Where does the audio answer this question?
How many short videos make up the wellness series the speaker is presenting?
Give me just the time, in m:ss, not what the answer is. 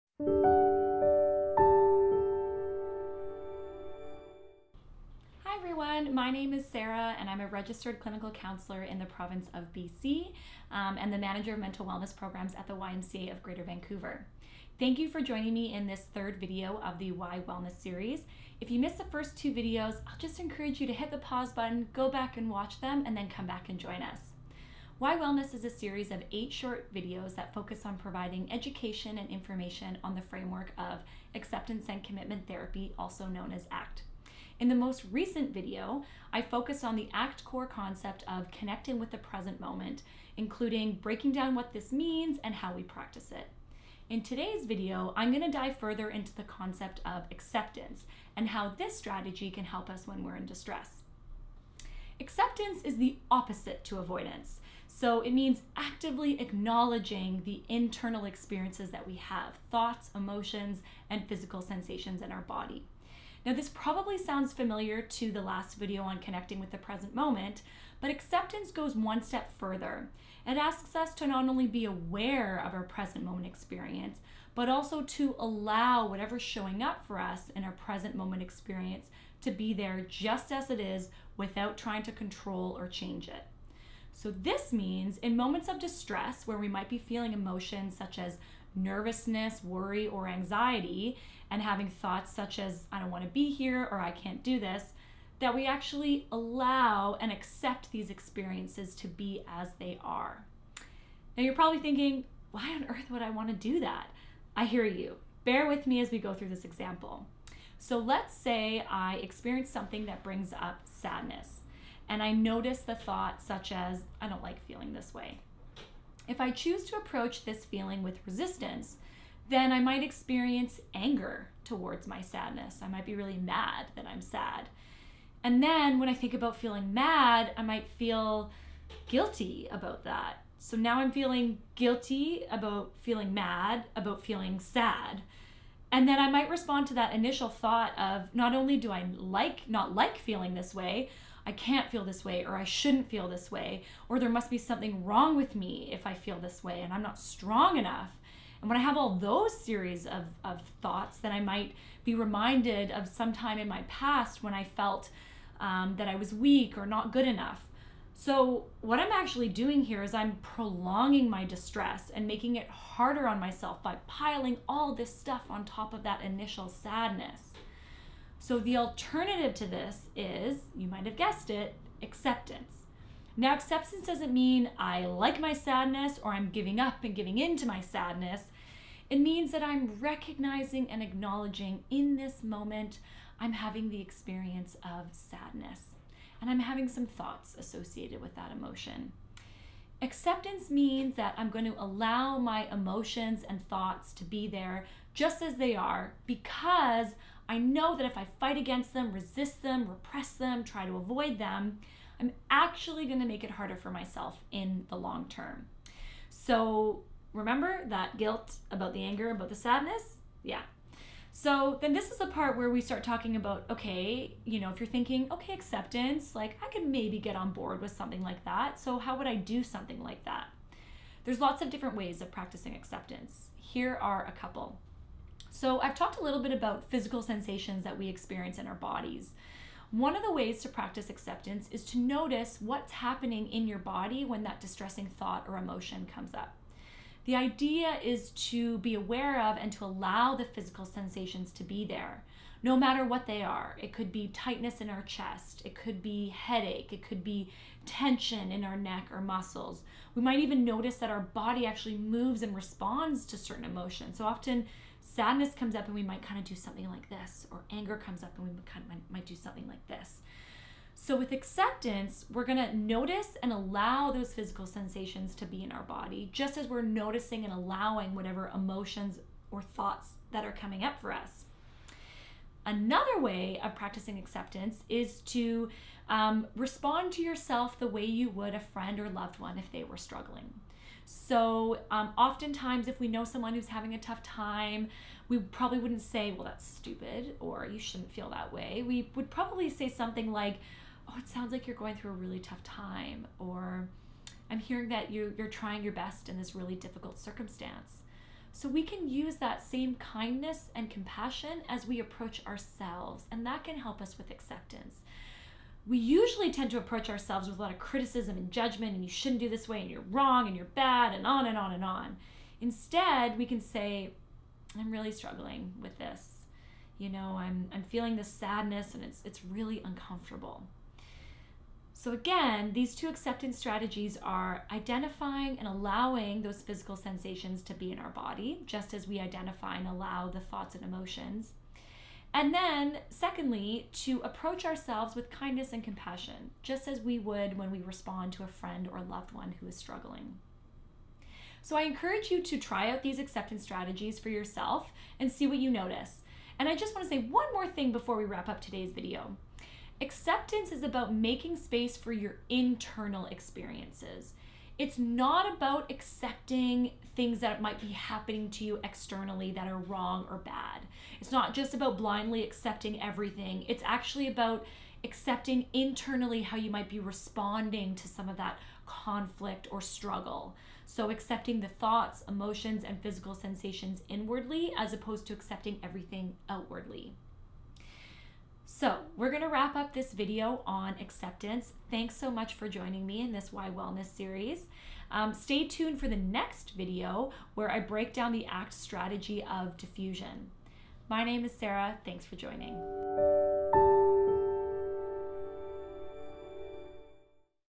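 0:26.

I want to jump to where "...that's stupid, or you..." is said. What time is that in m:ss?
4:46.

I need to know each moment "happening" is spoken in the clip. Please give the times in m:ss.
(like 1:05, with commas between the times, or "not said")
3:52, 5:57.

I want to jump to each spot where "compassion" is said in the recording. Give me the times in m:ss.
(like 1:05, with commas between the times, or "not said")
5:00, 5:35.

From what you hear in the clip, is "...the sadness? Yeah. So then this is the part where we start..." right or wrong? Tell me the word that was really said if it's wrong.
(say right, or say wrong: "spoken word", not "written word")
right.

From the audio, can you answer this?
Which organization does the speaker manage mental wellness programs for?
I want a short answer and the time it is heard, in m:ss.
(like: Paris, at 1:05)
YMCA of Greater Vancouver, at 0:12.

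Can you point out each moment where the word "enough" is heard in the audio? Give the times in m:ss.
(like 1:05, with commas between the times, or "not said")
2:27, 2:37.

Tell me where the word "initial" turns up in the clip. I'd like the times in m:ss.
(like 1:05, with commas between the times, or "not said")
2:17, 2:46.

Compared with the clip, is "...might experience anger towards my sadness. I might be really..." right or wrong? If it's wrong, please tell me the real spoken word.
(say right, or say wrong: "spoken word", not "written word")
right.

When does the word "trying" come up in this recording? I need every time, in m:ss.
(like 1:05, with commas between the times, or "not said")
1:21, 4:55.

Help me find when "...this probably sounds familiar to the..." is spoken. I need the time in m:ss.
1:03.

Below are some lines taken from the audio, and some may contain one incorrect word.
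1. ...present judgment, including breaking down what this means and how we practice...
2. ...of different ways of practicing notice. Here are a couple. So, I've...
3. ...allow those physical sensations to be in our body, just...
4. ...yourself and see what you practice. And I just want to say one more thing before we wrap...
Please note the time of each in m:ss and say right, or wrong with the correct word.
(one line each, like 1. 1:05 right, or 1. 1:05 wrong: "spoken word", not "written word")
1. 0:39 wrong: "moment", not "judgment"
2. 3:41 wrong: "acceptance", not "notice"
3. 4:23 right
4. 5:44 wrong: "notice", not "practice".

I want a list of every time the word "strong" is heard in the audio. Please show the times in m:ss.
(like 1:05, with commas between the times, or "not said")
2:27.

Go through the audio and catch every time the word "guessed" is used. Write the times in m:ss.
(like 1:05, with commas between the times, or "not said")
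2:51.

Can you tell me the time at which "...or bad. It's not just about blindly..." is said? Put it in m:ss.
6:00.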